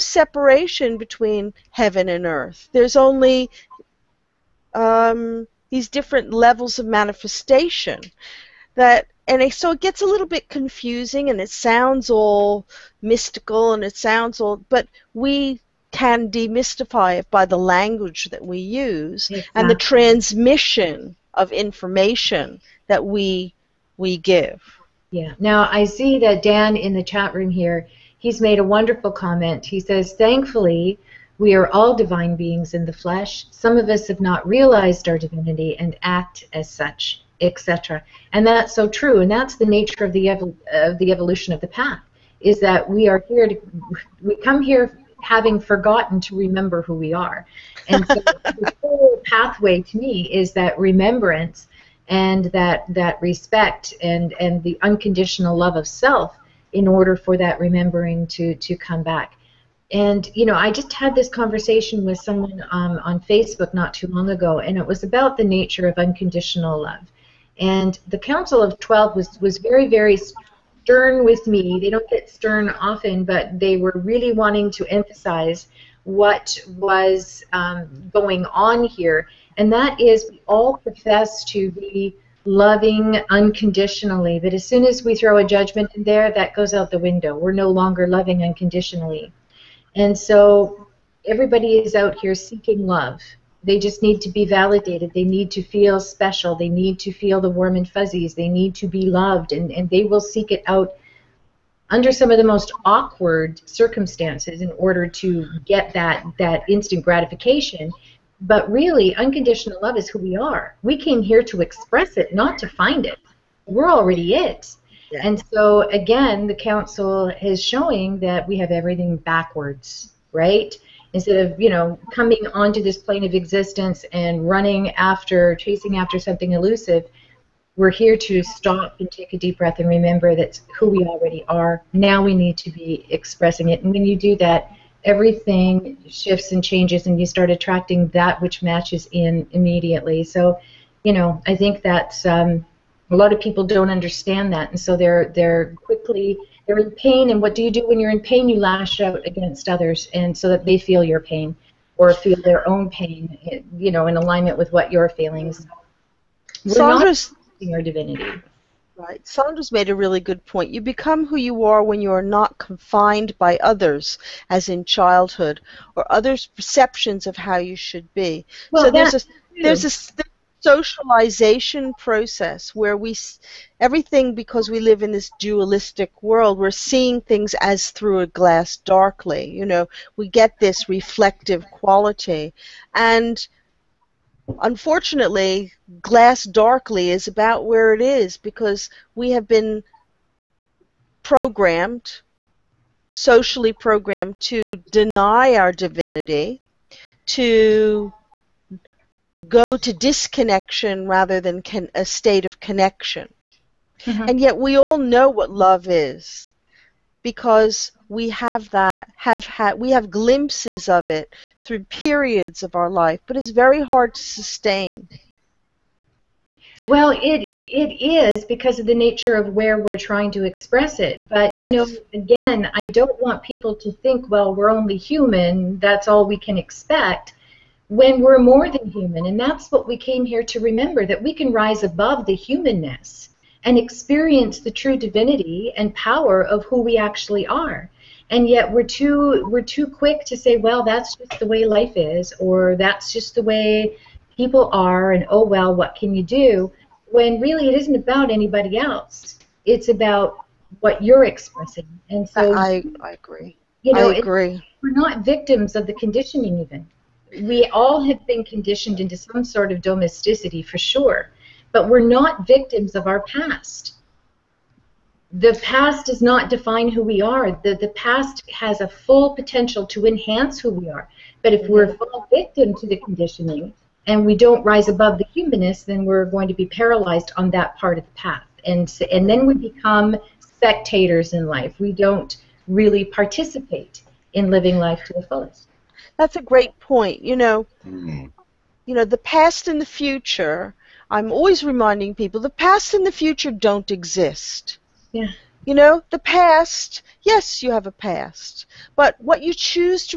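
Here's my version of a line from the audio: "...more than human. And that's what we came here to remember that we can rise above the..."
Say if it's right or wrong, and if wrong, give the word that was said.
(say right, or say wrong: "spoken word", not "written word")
right.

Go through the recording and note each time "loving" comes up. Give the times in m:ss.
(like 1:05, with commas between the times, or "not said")
1:22, 1:28.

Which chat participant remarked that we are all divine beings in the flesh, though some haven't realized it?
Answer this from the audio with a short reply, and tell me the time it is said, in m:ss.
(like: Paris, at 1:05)
Dan, at 0:26.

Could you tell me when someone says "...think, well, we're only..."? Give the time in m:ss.
3:43.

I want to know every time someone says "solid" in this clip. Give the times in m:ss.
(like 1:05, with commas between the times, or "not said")
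not said.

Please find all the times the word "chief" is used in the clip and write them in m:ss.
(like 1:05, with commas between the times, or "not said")
not said.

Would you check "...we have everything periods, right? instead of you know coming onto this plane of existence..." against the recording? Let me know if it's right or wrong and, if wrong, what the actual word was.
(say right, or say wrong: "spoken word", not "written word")
wrong: "backwards", not "periods".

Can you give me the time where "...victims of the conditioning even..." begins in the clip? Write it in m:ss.
4:15.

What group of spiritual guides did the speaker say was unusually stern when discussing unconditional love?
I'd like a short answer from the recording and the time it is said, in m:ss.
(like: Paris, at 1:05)
Council of Twelve, at 1:08.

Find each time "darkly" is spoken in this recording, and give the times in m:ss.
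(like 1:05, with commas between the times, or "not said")
2:58, 3:06.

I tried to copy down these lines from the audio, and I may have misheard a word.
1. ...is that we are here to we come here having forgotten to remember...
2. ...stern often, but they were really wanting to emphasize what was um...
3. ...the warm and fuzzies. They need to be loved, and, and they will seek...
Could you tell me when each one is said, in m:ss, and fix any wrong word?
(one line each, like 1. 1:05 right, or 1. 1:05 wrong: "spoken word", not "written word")
1. 0:42 right
2. 1:12 right
3. 1:37 right.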